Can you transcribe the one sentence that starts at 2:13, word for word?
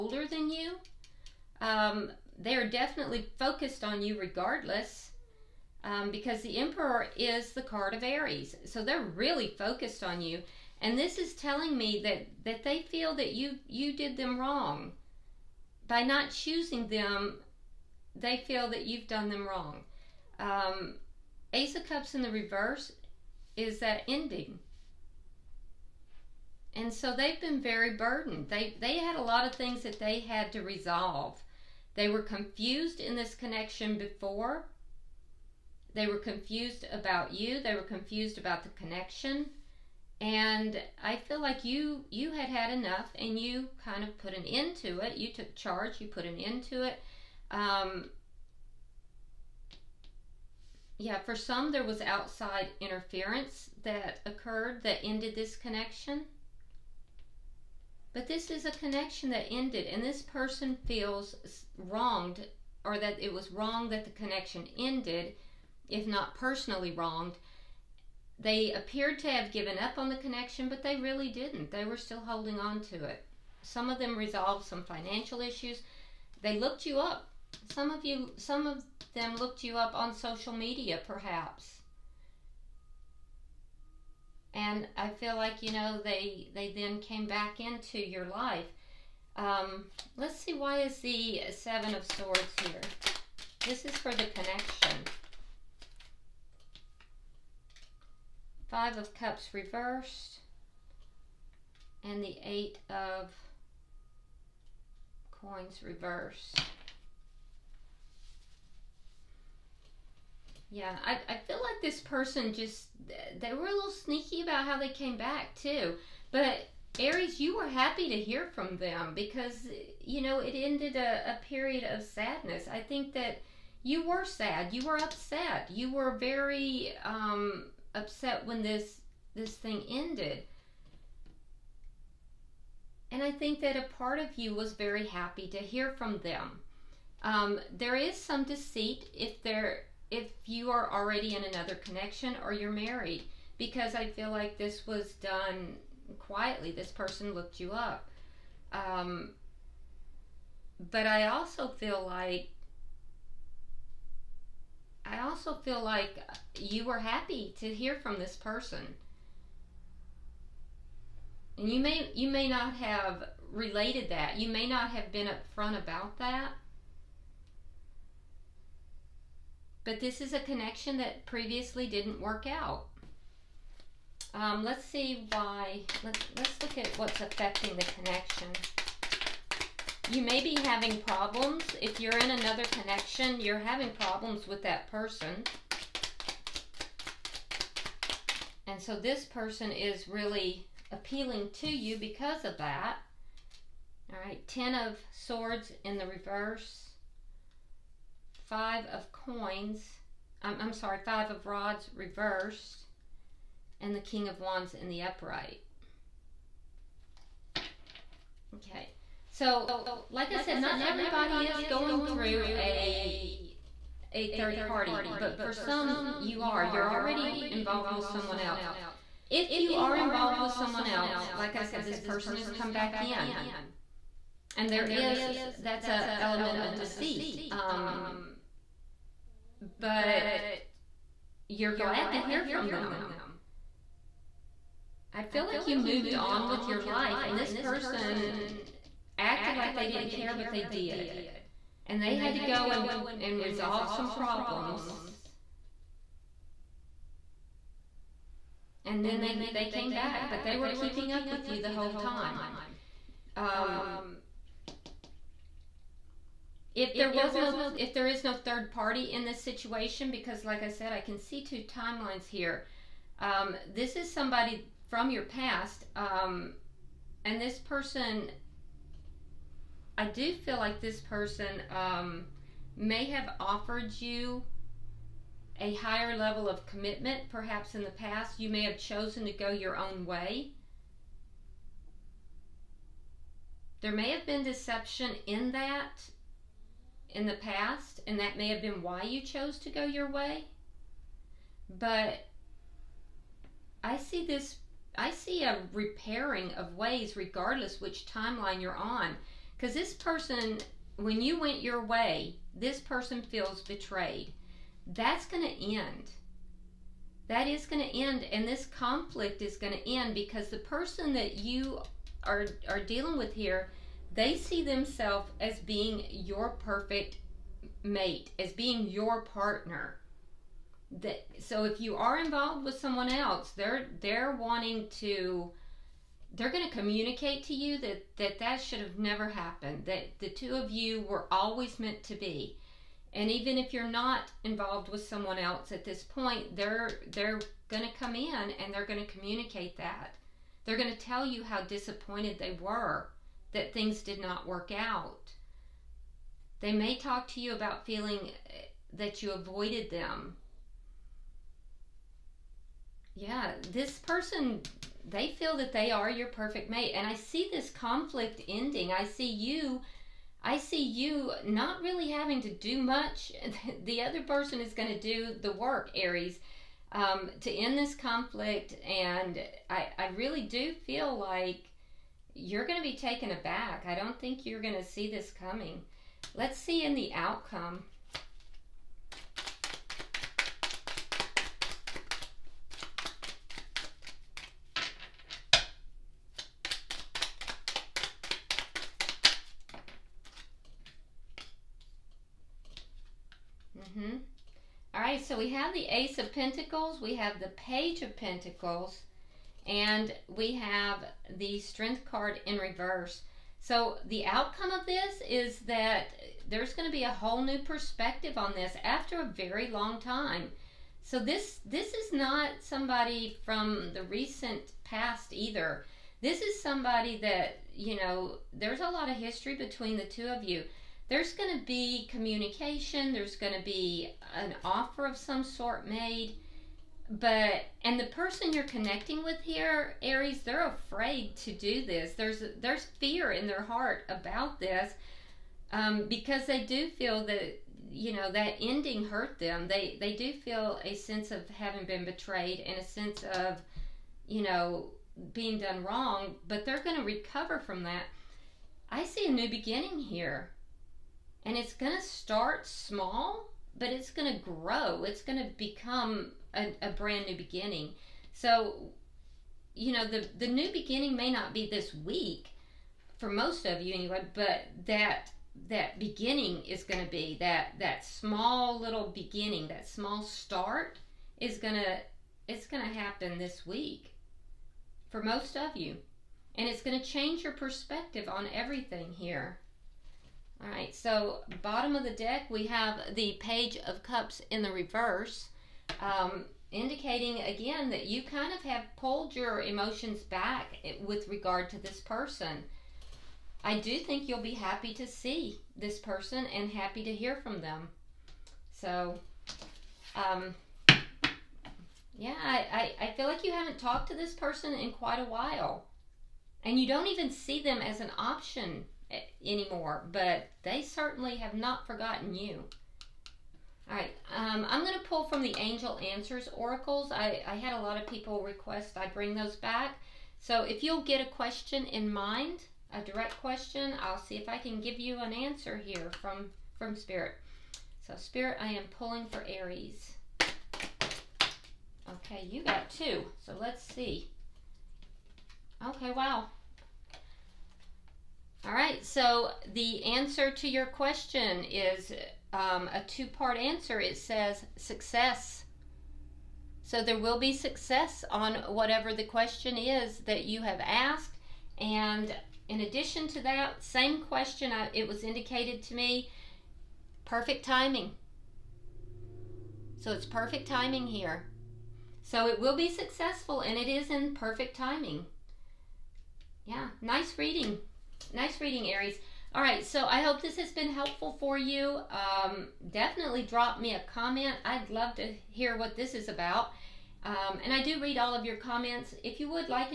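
And I think that a part of you was very happy to hear from them.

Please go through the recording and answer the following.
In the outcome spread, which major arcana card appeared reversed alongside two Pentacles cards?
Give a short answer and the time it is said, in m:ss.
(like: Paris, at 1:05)
Strength, at 6:41.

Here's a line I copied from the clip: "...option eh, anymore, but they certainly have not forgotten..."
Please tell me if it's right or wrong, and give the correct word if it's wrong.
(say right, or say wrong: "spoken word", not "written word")
right.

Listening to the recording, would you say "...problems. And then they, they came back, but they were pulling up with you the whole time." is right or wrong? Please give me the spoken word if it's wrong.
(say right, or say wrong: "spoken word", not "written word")
wrong: "keeping", not "pulling".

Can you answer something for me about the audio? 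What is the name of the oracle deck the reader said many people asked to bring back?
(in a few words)
Angel Answers Oracles.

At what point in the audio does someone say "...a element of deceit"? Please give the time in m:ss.
3:45.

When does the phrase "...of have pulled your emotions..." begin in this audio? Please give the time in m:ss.
8:08.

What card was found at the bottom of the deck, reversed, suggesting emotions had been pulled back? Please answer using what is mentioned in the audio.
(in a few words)
Page of Cups.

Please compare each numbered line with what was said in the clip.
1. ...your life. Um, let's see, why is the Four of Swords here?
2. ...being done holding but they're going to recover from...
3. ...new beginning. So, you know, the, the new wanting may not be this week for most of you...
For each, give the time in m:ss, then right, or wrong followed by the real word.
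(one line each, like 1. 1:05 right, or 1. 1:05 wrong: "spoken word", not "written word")
1. 1:27 wrong: "Seven", not "Four"
2. 7:25 wrong: "wrong", not "holding"
3. 7:37 wrong: "beginning", not "wanting".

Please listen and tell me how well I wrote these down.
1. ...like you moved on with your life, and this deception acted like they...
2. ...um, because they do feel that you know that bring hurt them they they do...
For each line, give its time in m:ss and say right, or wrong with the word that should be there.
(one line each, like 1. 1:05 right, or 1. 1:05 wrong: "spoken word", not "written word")
1. 3:55 wrong: "person", not "deception"
2. 7:15 wrong: "ending", not "bring".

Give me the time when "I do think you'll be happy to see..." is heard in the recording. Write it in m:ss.
8:13.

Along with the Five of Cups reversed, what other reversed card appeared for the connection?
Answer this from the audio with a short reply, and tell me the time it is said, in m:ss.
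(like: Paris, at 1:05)
Eight of Coins, at 1:42.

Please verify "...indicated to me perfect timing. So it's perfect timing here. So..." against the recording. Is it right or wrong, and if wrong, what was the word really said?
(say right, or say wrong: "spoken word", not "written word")
right.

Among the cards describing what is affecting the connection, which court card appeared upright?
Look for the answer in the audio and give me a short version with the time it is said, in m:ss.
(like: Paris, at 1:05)
King of Wands, at 3:23.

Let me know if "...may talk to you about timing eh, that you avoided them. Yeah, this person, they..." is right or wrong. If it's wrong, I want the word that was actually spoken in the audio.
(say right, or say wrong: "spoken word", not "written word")
wrong: "feeling", not "timing".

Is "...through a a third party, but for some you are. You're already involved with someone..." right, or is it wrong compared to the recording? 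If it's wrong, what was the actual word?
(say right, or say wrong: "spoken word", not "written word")
right.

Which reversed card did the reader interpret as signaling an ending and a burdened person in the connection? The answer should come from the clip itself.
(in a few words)
Ace of Cups.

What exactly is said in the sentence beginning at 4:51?
But I see this, I see a repairing of ways regardless which timeline you're on.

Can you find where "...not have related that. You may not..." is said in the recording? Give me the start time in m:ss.
2:42.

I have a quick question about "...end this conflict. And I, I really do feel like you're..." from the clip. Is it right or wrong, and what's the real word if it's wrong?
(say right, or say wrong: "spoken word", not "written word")
right.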